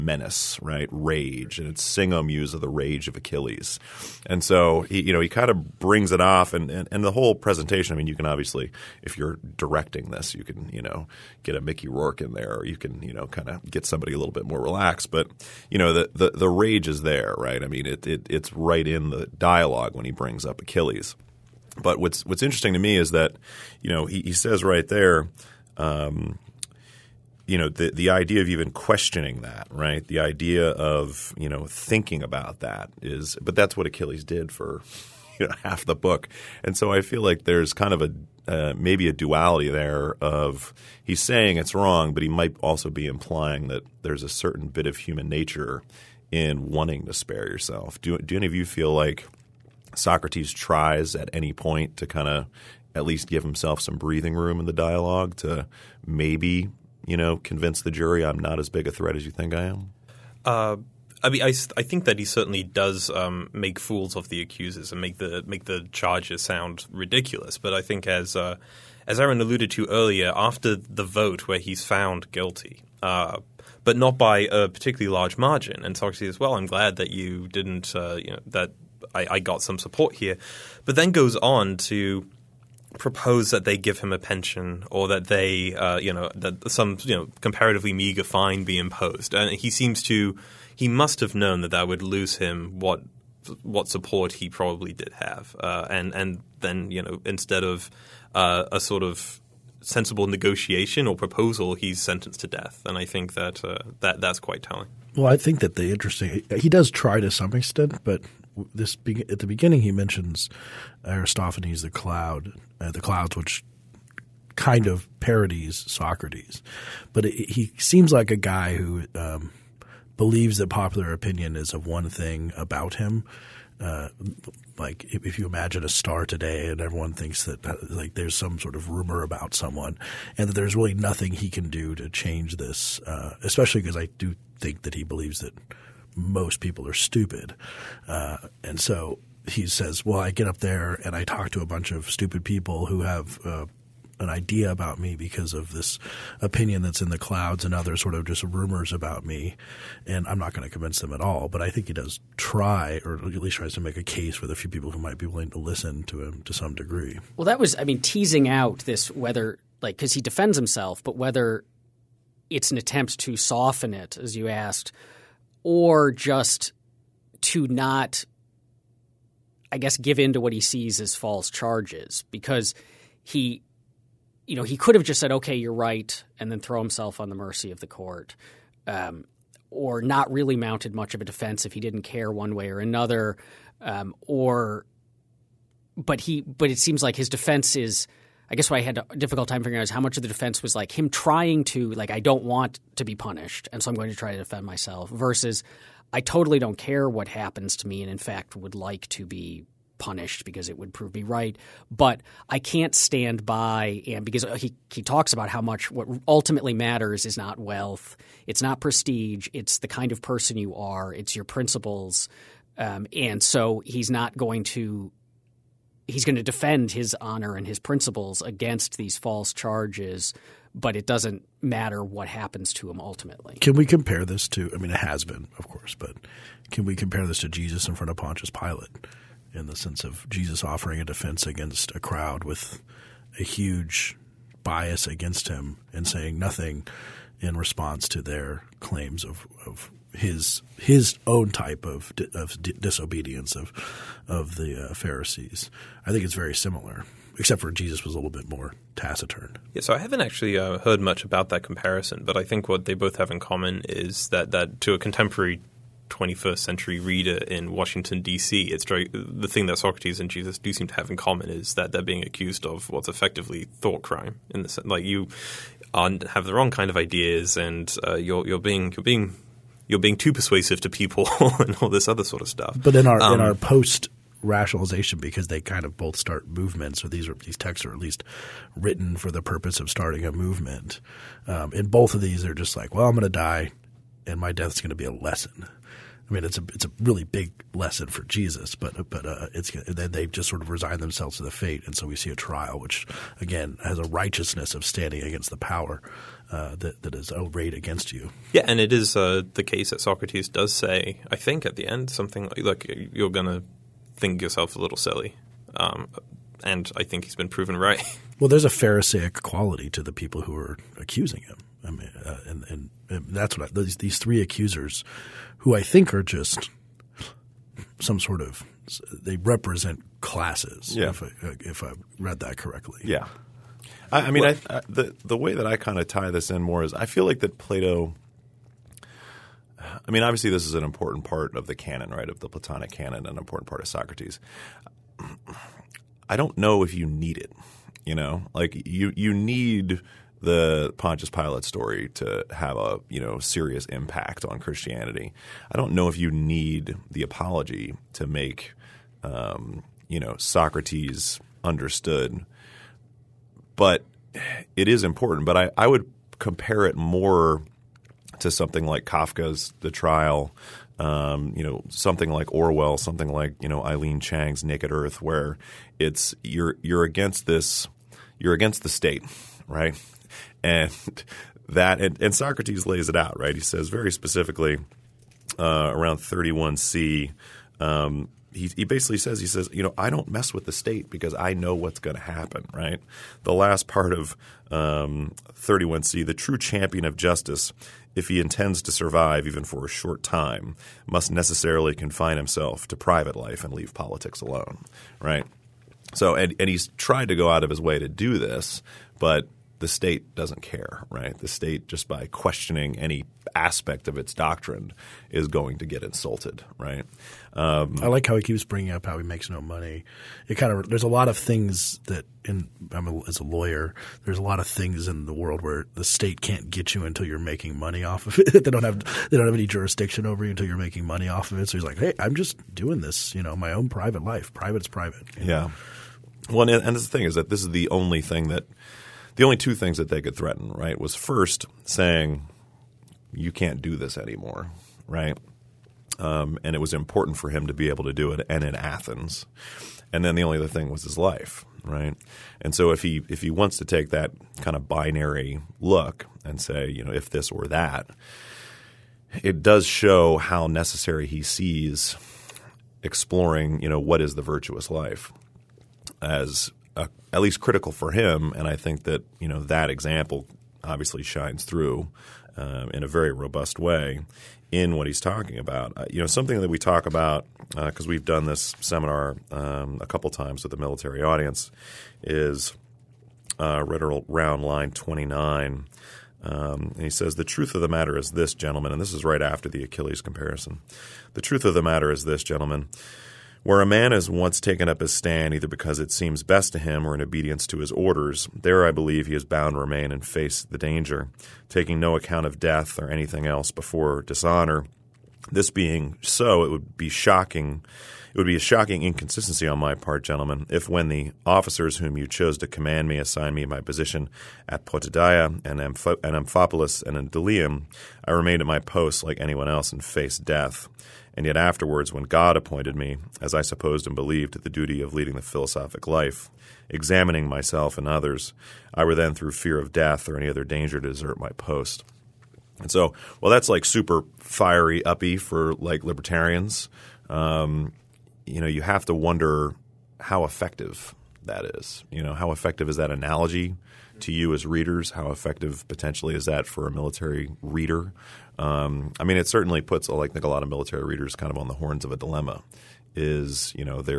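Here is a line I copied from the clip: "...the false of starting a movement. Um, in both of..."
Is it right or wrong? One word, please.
wrong.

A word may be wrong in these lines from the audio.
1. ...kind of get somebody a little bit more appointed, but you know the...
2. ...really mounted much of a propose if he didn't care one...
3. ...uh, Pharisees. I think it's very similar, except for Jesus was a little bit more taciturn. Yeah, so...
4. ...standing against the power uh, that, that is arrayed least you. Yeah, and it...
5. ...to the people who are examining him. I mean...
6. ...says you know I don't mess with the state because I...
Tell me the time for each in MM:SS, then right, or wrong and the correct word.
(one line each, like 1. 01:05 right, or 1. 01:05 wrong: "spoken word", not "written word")
1. 00:13 wrong: "relaxed", not "appointed"
2. 03:00 wrong: "defense", not "propose"
3. 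04:04 right
4. 04:54 wrong: "against", not "least"
5. 05:09 wrong: "accusing", not "examining"
6. 06:19 right.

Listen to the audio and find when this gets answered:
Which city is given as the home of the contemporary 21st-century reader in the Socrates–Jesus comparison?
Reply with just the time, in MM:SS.
04:17.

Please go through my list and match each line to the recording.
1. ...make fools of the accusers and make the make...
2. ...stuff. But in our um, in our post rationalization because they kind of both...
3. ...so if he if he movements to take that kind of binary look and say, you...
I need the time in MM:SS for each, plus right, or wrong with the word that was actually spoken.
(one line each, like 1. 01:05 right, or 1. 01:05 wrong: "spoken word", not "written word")
1. 01:03 right
2. 04:32 right
3. 07:22 wrong: "wants", not "movements".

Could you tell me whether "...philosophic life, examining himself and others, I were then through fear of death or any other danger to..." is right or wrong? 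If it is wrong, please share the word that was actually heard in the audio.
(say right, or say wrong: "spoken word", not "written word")
wrong: "myself", not "himself".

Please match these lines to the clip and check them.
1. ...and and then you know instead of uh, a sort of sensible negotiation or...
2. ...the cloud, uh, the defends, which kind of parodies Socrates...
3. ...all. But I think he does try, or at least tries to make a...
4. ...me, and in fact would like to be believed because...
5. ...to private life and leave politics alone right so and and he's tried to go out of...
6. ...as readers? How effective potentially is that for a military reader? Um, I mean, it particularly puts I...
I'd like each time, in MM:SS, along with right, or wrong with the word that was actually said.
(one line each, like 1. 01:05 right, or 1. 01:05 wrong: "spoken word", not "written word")
1. 01:35 right
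2. 01:51 wrong: "clouds", not "defends"
3. 02:31 right
4. 03:17 wrong: "punished", not "believed"
5. 06:32 right
6. 08:54 wrong: "certainly", not "particularly".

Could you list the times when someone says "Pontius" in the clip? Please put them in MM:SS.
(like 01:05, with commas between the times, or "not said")
03:48, 05:40.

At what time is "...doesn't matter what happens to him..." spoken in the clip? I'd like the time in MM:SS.
03:41.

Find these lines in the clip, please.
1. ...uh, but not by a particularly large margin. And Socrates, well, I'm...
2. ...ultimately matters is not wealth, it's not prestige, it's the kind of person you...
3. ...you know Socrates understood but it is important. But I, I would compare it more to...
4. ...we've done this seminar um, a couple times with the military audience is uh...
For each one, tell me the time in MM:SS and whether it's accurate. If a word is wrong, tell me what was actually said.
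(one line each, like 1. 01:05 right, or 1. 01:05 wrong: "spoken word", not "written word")
1. 01:13 right
2. 03:26 right
3. 05:50 right
4. 07:48 right.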